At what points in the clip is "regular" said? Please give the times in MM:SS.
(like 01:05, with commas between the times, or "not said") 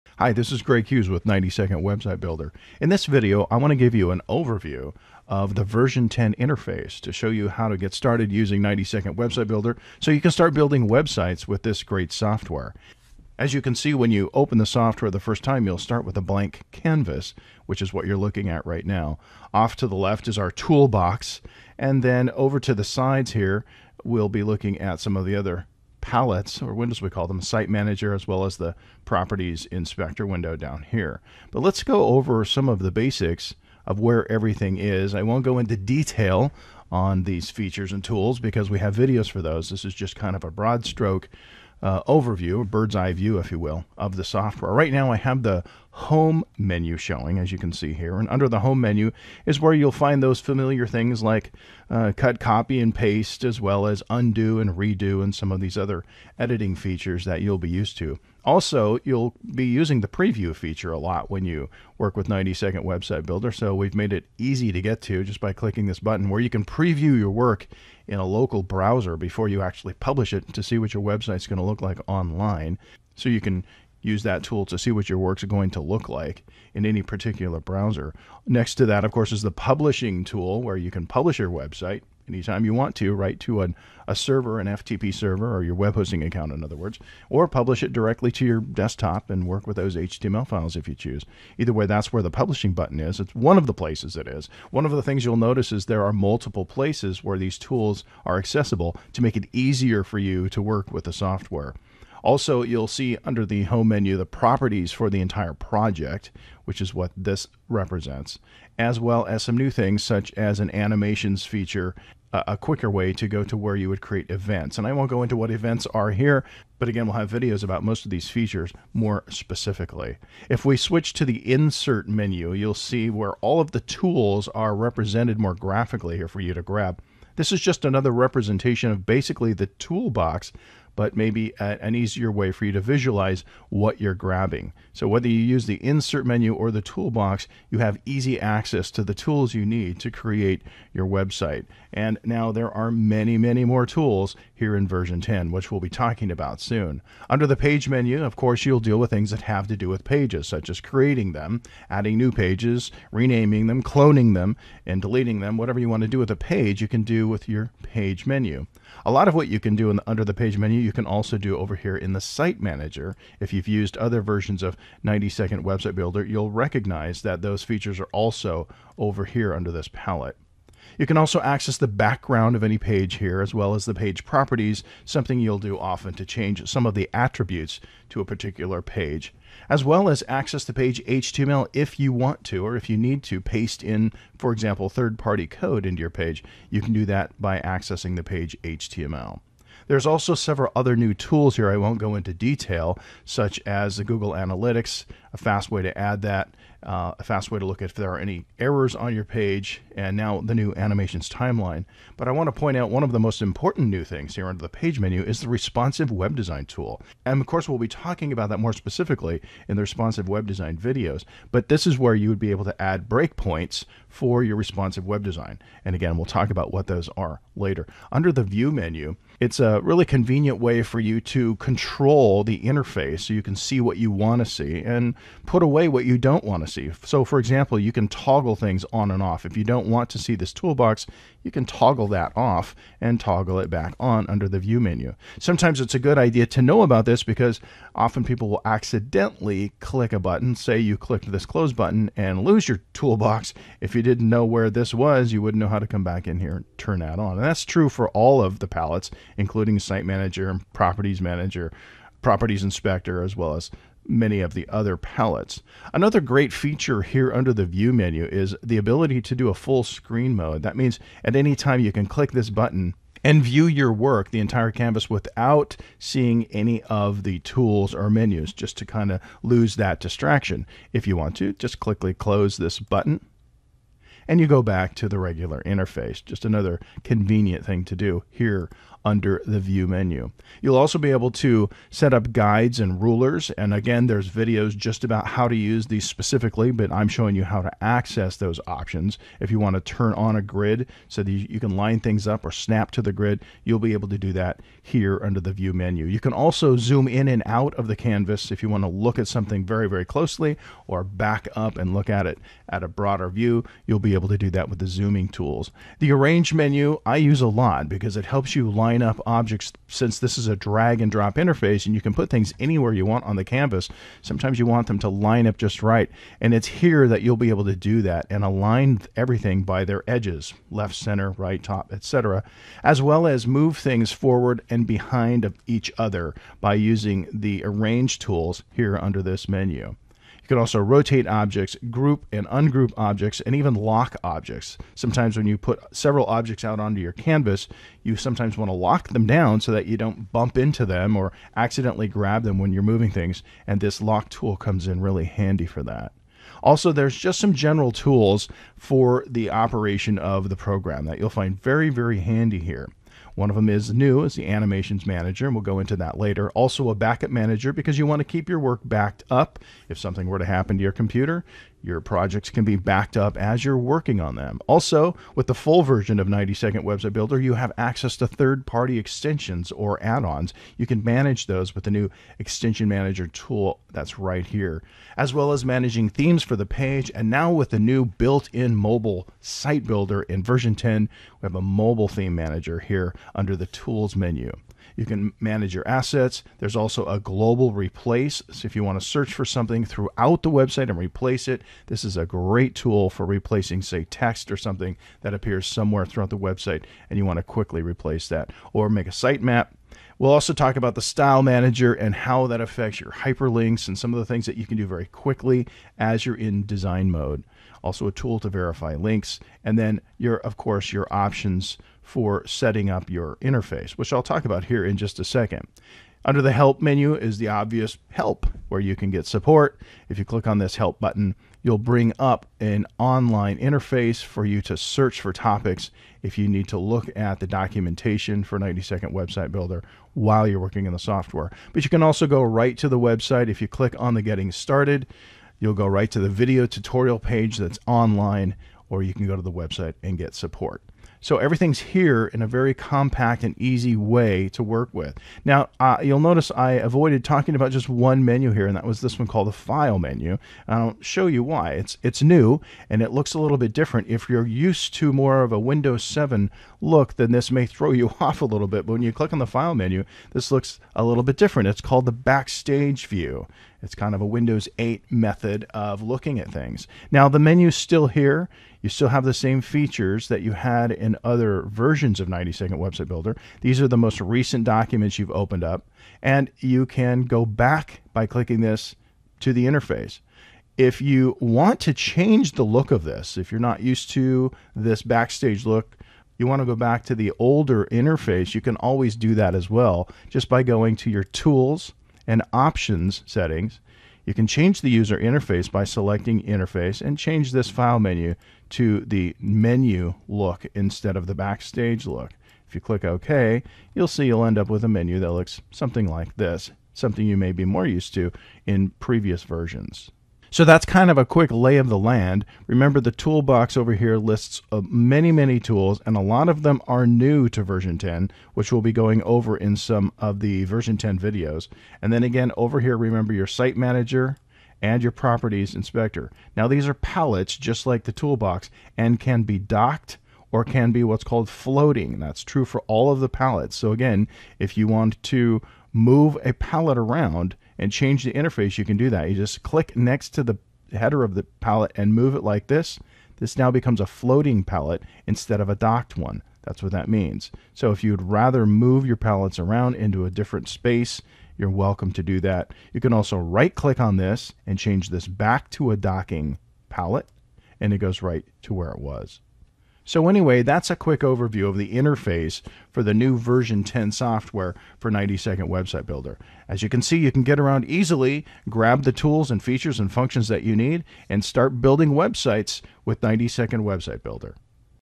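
04:35.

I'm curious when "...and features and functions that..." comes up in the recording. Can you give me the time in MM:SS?
09:29.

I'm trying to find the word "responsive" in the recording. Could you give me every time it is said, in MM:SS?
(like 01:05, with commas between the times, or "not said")
03:25, 03:29, 03:34.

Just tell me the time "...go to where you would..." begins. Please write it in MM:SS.
01:53.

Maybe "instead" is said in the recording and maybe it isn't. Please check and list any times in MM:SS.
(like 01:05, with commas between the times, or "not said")
08:20, 09:05.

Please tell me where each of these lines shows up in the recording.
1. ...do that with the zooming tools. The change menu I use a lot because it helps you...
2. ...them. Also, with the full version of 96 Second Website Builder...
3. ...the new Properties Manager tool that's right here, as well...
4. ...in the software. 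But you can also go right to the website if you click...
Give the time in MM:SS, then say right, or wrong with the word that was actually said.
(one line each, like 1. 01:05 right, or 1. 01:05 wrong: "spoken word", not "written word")
1. 05:04 wrong: "arrange", not "change"
2. 06:04 wrong: "90", not "96"
3. 06:11 wrong: "Extension", not "Properties"
4. 07:10 right.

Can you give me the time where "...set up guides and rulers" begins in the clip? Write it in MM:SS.
04:41.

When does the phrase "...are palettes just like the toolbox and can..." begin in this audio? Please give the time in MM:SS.
08:46.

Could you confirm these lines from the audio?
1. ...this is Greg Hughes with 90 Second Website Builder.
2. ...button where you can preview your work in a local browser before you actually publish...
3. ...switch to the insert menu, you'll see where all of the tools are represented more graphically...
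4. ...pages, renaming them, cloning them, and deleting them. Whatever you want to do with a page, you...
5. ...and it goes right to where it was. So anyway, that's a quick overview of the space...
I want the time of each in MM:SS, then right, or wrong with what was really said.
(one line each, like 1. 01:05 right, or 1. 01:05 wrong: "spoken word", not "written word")
1. 00:00 right
2. 01:05 right
3. 02:00 right
4. 02:32 right
5. 09:17 wrong: "interface", not "space".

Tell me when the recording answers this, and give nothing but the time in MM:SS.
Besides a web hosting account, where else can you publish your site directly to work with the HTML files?
01:28.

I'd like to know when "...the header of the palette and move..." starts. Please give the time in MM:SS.
09:00.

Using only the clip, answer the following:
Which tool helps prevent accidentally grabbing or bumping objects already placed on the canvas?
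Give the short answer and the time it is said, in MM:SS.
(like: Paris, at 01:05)
lock tool, at 05:44.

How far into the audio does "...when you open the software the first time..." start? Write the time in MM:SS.
00:13.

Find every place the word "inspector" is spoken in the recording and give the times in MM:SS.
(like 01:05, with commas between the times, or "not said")
00:29, 04:12, 08:45.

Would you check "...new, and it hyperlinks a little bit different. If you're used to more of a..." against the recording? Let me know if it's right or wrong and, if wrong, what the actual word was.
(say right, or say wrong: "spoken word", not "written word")
wrong: "looks", not "hyperlinks".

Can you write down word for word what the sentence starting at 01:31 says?
Either way, that's where the publishing button is.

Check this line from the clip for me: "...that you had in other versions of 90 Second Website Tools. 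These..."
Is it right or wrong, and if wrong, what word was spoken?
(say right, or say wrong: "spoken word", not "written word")
wrong: "Builder", not "Tools".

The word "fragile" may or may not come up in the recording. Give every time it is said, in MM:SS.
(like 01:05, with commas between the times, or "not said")
not said.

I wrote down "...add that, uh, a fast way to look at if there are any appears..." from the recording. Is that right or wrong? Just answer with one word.
wrong.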